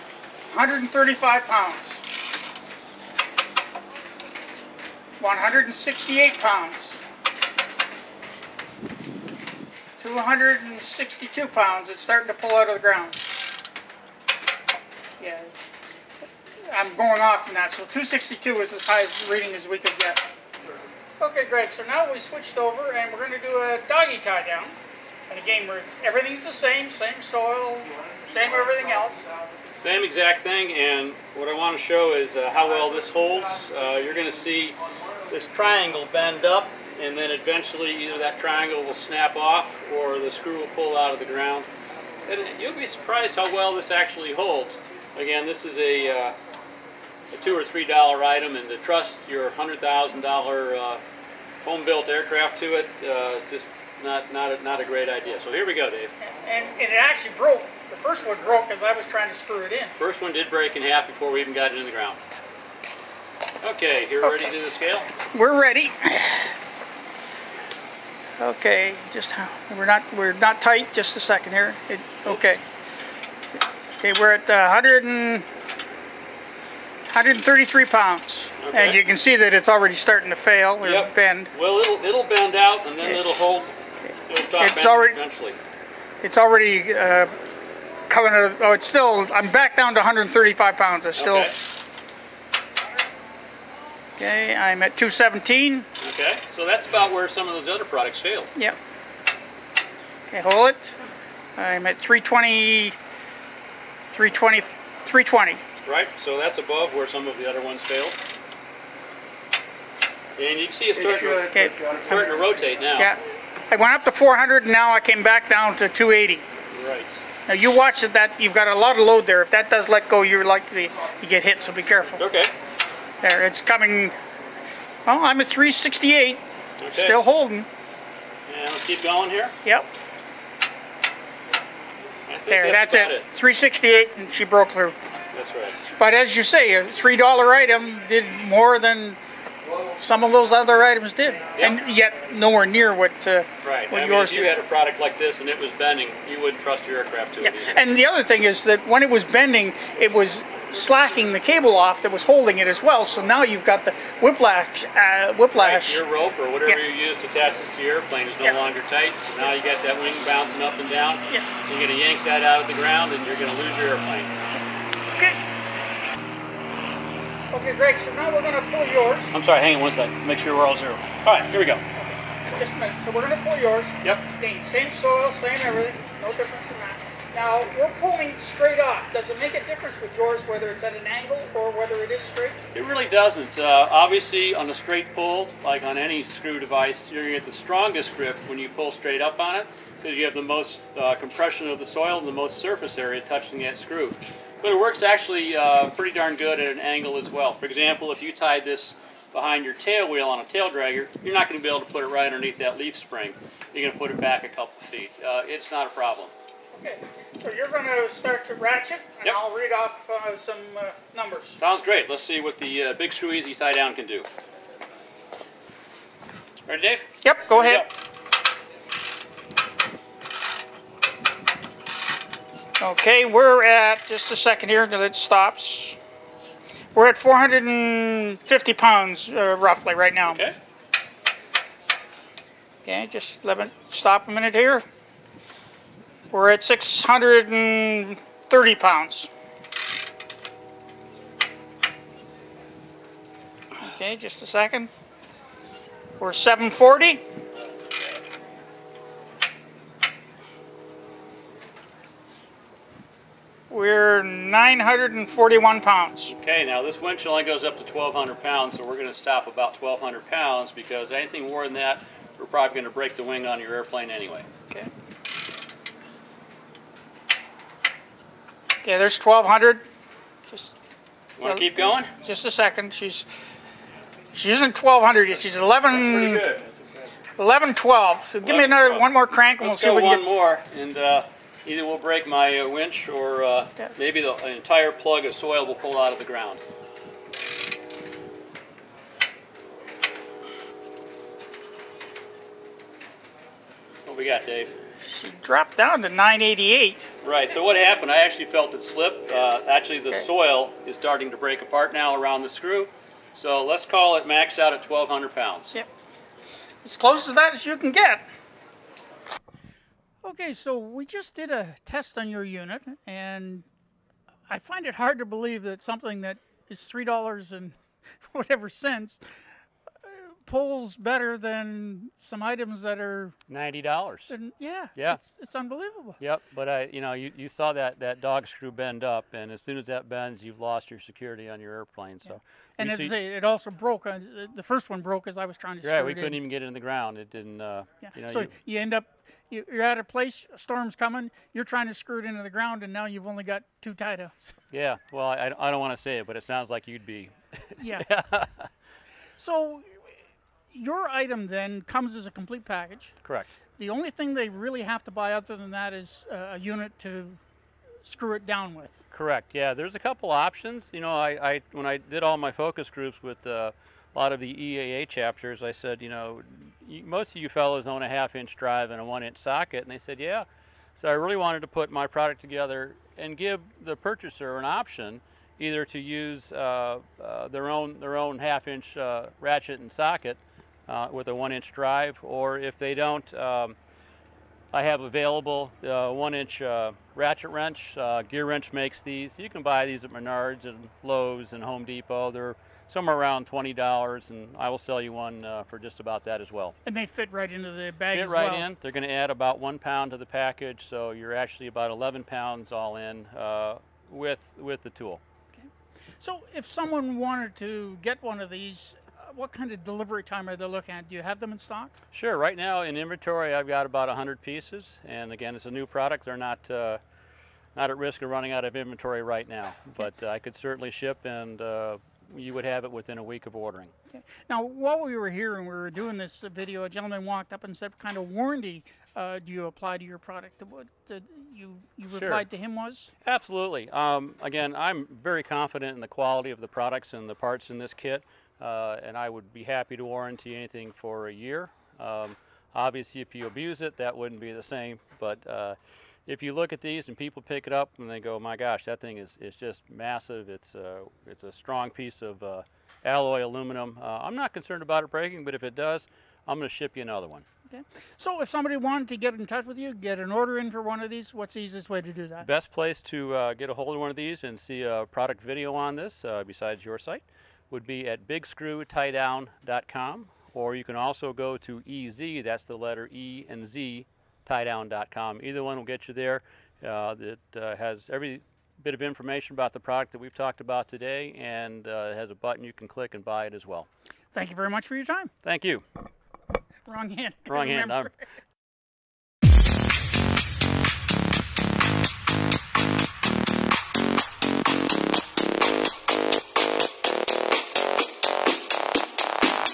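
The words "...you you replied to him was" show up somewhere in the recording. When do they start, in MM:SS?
07:11.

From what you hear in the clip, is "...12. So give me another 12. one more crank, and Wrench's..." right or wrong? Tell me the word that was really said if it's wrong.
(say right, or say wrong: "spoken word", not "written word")
wrong: "Let", not "Wrench".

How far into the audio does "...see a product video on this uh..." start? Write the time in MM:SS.
07:44.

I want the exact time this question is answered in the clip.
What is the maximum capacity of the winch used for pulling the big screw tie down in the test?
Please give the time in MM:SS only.
04:16.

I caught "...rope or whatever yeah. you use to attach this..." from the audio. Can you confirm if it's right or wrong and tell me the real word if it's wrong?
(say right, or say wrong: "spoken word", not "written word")
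right.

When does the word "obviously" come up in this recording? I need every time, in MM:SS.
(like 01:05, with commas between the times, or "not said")
03:03, 07:22.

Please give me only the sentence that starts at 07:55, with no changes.
Either one will get you there.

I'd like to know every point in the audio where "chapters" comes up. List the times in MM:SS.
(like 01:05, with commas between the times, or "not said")
06:05.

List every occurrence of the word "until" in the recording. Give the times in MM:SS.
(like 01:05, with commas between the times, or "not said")
03:44.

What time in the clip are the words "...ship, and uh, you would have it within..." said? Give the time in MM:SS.
07:00.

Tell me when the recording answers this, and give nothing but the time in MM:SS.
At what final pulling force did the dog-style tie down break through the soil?
02:13.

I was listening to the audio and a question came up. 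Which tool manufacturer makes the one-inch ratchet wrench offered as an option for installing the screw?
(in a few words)
Gear Wrench.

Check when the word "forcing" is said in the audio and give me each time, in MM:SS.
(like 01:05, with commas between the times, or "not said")
not said.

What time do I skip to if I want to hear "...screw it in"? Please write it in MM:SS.
00:59.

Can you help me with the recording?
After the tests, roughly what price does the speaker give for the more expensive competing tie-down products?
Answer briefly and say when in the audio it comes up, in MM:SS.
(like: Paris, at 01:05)
$90, at 05:23.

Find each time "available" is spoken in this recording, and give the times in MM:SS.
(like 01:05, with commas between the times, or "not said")
06:25.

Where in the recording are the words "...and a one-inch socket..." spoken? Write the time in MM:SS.
06:08.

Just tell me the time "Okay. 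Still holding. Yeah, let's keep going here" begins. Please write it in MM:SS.
02:06.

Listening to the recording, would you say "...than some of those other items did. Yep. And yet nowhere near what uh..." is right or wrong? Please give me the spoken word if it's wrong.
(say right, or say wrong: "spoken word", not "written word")
right.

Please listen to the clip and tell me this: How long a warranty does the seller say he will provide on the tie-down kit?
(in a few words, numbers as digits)
1 year.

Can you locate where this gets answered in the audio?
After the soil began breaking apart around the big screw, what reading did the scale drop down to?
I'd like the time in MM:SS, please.
04:56.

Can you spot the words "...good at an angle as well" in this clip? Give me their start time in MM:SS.
03:16.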